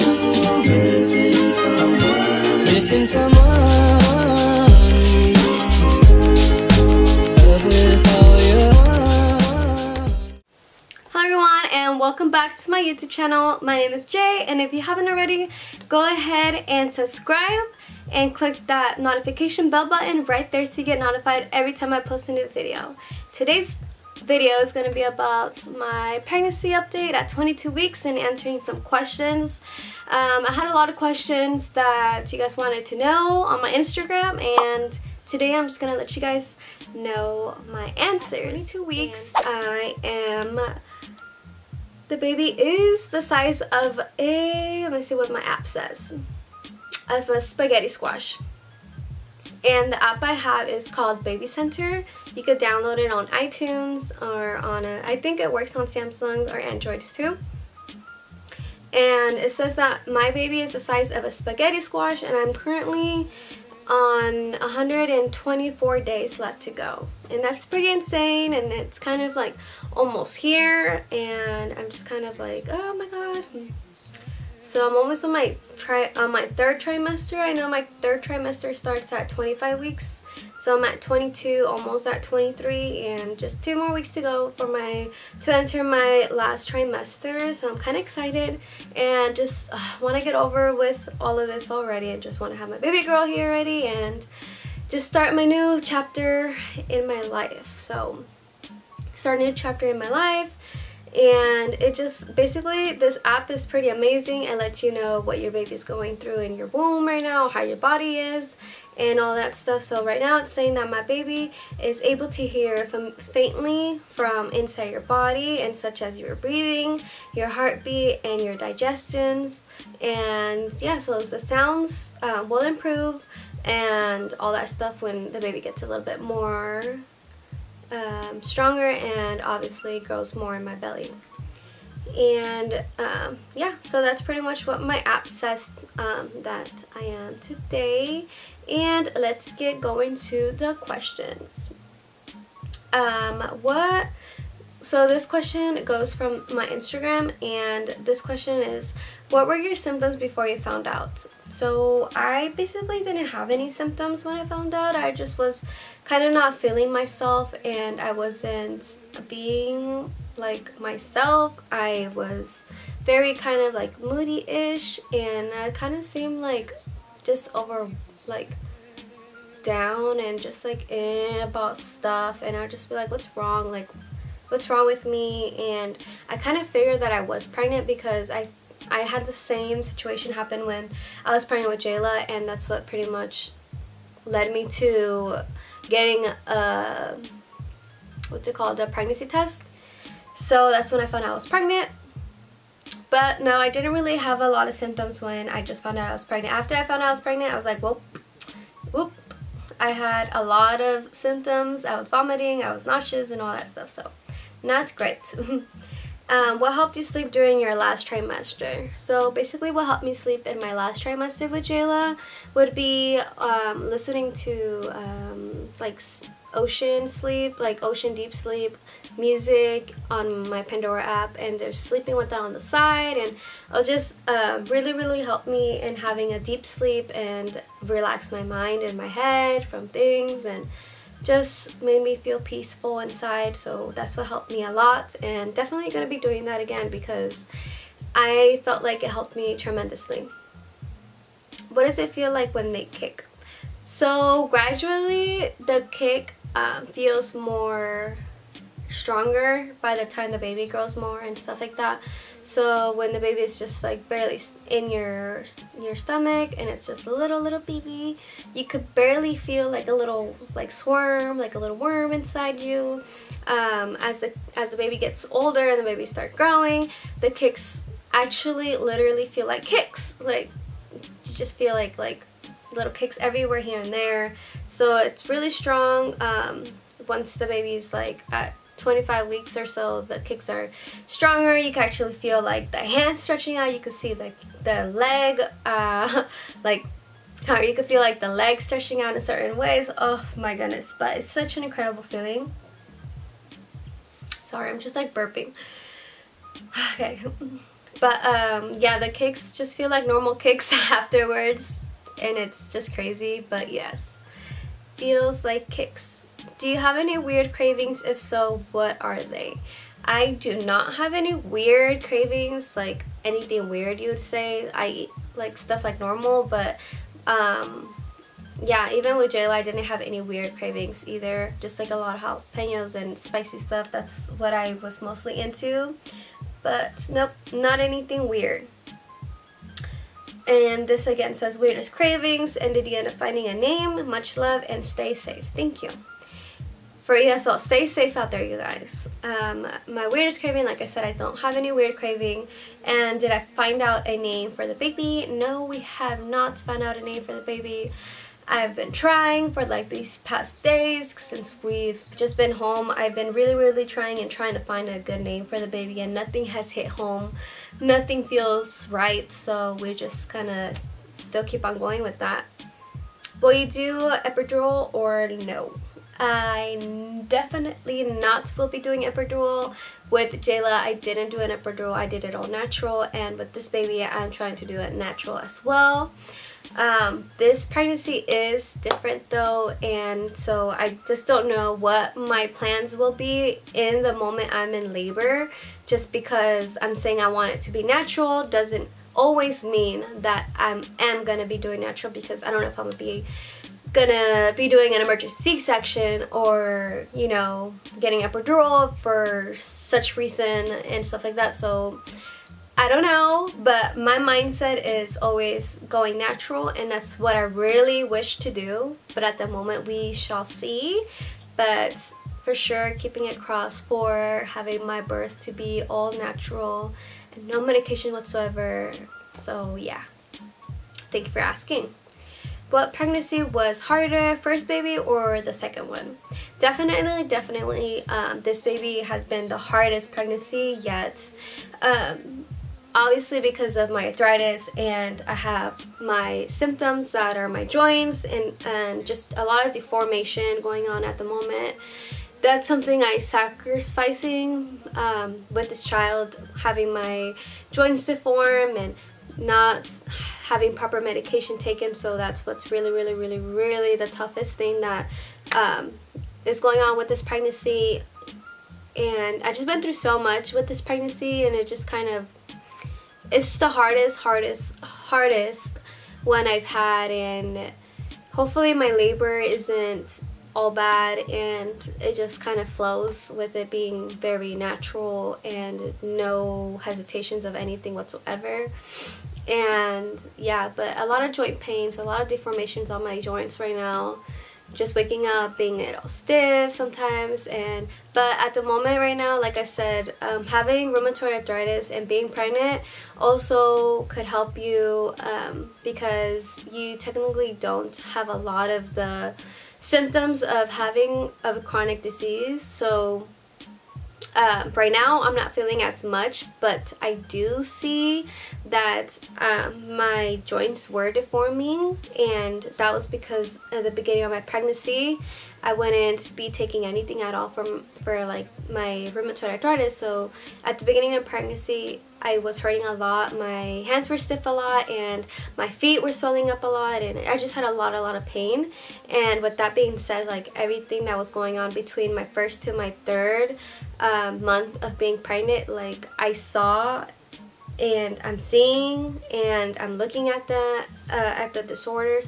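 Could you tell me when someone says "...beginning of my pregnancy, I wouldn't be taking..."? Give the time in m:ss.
8:33.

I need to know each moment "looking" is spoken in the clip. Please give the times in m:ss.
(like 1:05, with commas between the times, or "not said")
8:59.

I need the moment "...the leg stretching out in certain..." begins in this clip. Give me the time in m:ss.
4:48.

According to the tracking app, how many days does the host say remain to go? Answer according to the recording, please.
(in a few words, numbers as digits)
124.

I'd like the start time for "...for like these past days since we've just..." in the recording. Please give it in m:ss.
5:49.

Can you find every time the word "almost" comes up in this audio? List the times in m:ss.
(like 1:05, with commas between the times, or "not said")
1:09, 1:14, 1:21.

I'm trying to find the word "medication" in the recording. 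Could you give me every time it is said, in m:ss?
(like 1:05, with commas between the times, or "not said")
6:57, 7:30.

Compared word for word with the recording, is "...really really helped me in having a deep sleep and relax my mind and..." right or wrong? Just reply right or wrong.
right.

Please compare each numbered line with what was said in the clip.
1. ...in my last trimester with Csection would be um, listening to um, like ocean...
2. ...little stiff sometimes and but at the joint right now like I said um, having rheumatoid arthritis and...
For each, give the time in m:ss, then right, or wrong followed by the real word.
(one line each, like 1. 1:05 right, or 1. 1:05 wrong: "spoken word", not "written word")
1. 3:30 wrong: "Jayla", not "Csection"
2. 8:05 wrong: "moment", not "joint".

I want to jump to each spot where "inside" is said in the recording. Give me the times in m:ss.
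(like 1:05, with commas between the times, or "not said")
1:54, 3:52, 4:22.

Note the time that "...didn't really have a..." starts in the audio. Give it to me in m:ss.
3:13.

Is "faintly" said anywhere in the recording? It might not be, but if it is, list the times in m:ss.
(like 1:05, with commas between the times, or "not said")
1:53.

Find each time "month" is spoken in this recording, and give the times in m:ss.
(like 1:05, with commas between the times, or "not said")
8:54.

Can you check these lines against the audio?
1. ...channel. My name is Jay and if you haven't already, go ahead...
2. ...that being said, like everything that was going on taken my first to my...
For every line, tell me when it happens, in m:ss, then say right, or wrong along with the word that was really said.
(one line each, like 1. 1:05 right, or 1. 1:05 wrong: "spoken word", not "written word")
1. 0:13 right
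2. 8:49 wrong: "between", not "taken".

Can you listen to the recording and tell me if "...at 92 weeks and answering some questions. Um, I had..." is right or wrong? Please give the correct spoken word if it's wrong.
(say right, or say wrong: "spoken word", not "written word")
wrong: "22", not "92".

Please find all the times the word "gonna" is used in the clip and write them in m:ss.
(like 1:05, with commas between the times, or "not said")
6:00, 6:33.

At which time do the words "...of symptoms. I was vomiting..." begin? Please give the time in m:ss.
3:20.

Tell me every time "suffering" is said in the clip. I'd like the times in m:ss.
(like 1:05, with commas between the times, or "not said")
not said.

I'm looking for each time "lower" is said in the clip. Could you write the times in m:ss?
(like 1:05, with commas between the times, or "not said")
not said.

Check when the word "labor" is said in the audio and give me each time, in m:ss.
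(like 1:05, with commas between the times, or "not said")
6:24, 7:48.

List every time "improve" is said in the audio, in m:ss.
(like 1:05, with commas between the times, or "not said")
2:02.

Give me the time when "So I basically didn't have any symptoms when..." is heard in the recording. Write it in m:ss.
2:31.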